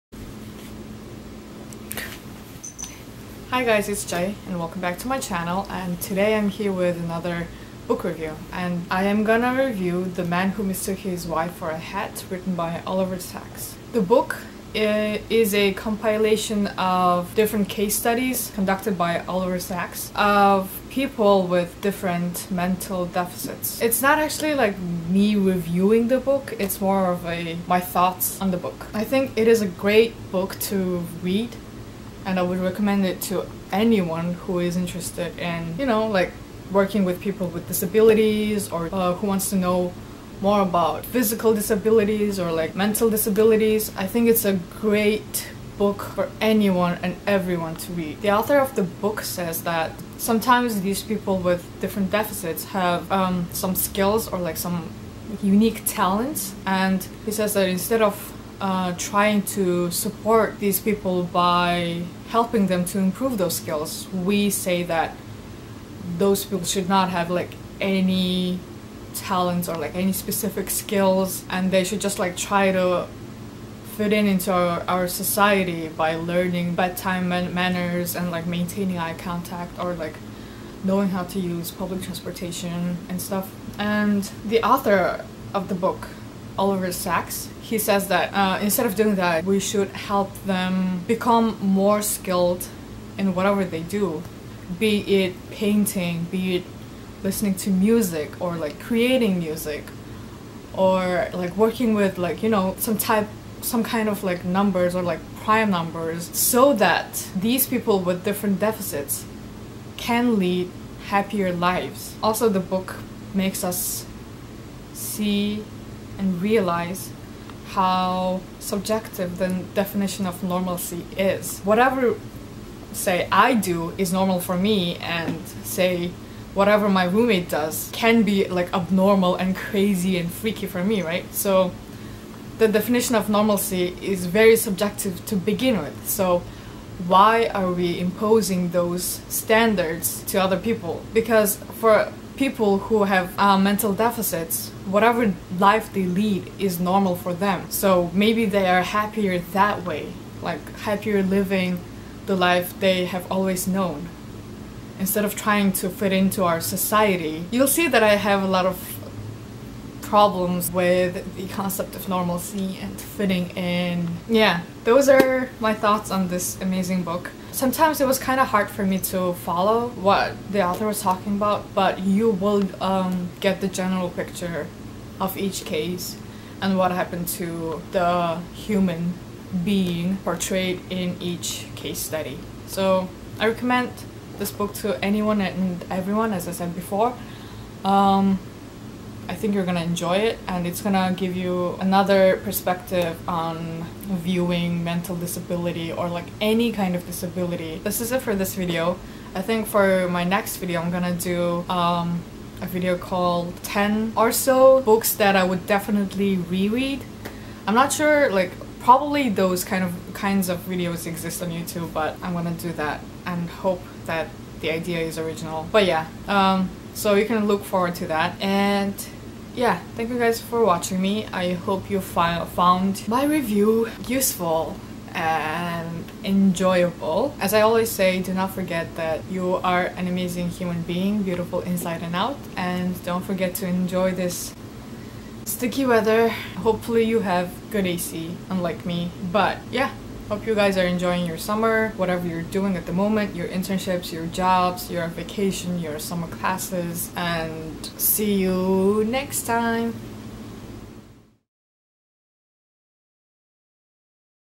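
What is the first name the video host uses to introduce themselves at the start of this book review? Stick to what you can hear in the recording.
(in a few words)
Jay.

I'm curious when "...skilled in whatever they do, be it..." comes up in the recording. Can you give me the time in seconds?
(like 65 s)
92 s.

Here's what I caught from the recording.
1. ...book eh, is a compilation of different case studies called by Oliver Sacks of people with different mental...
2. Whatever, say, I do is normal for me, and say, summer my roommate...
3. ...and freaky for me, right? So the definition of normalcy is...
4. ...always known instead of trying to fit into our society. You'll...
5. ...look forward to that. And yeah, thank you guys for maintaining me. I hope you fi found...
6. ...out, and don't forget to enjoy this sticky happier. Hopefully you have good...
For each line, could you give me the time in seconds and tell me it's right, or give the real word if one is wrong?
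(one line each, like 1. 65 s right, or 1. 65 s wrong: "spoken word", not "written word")
1. 14 s wrong: "conducted", not "called"
2. 121 s wrong: "whatever", not "summer"
3. 130 s right
4. 153 s right
5. 217 s wrong: "watching", not "maintaining"
6. 232 s wrong: "weather", not "happier".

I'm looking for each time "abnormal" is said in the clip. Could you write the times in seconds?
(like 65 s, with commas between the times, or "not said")
128 s.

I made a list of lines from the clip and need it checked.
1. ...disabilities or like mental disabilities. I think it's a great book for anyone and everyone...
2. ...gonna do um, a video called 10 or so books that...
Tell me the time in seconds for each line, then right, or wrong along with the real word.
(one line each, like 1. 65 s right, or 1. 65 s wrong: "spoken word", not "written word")
1. 41 s right
2. 200 s right.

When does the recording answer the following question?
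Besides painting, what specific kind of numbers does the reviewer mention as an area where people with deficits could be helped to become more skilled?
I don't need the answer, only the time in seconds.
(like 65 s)
105 s.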